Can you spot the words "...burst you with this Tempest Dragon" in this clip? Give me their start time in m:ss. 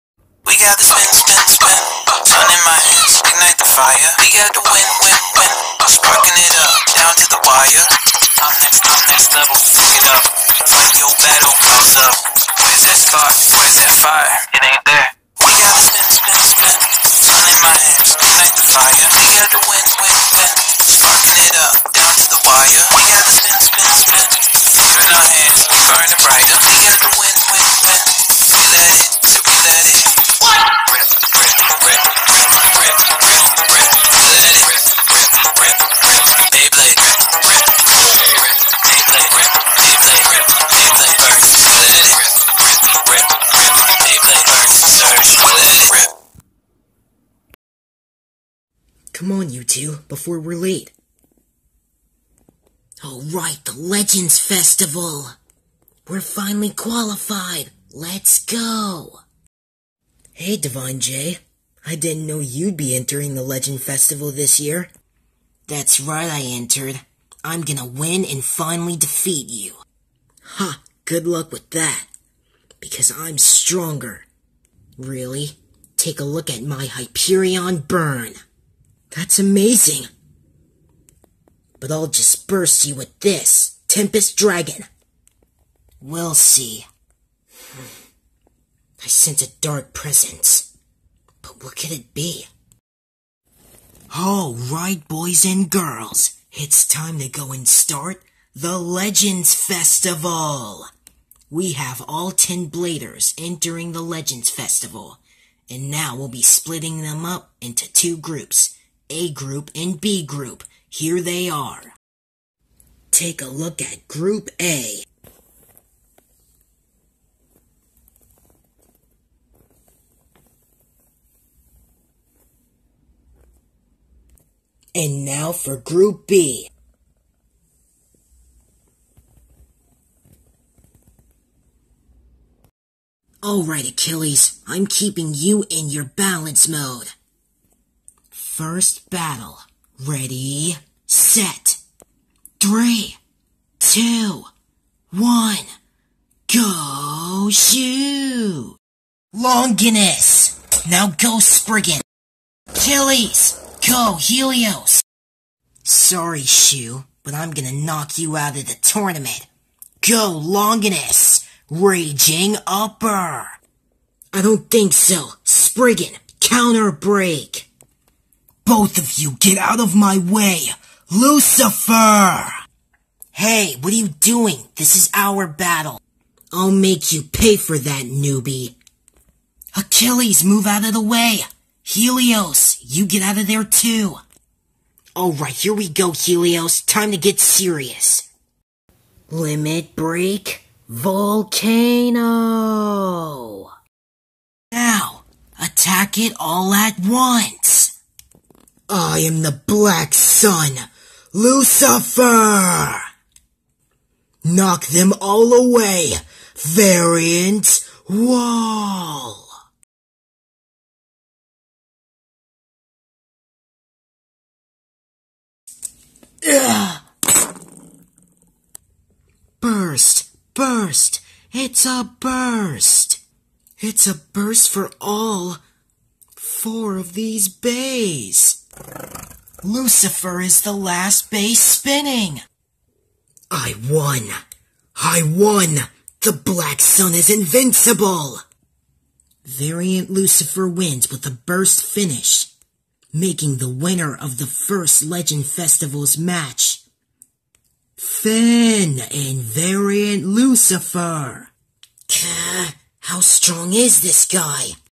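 1:22.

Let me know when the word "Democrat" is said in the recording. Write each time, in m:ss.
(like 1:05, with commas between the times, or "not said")
not said.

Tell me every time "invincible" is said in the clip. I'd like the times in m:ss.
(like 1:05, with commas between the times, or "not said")
3:57.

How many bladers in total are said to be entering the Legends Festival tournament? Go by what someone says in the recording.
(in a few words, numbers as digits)
10.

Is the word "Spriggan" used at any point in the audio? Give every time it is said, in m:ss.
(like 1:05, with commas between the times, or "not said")
2:31, 2:45.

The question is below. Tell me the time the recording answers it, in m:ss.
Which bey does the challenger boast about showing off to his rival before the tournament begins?
1:16.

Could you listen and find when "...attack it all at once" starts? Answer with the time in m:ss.
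3:15.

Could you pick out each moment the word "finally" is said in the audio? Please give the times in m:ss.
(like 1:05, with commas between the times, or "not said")
0:56, 1:08.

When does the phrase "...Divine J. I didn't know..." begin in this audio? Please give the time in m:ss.
1:00.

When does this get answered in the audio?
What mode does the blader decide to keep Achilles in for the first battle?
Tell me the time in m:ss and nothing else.
2:16.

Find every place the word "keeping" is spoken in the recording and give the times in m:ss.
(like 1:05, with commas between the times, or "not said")
2:14.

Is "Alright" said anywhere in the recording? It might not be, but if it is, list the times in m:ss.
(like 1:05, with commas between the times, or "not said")
2:13, 3:05.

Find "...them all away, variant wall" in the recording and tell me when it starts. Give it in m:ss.
3:24.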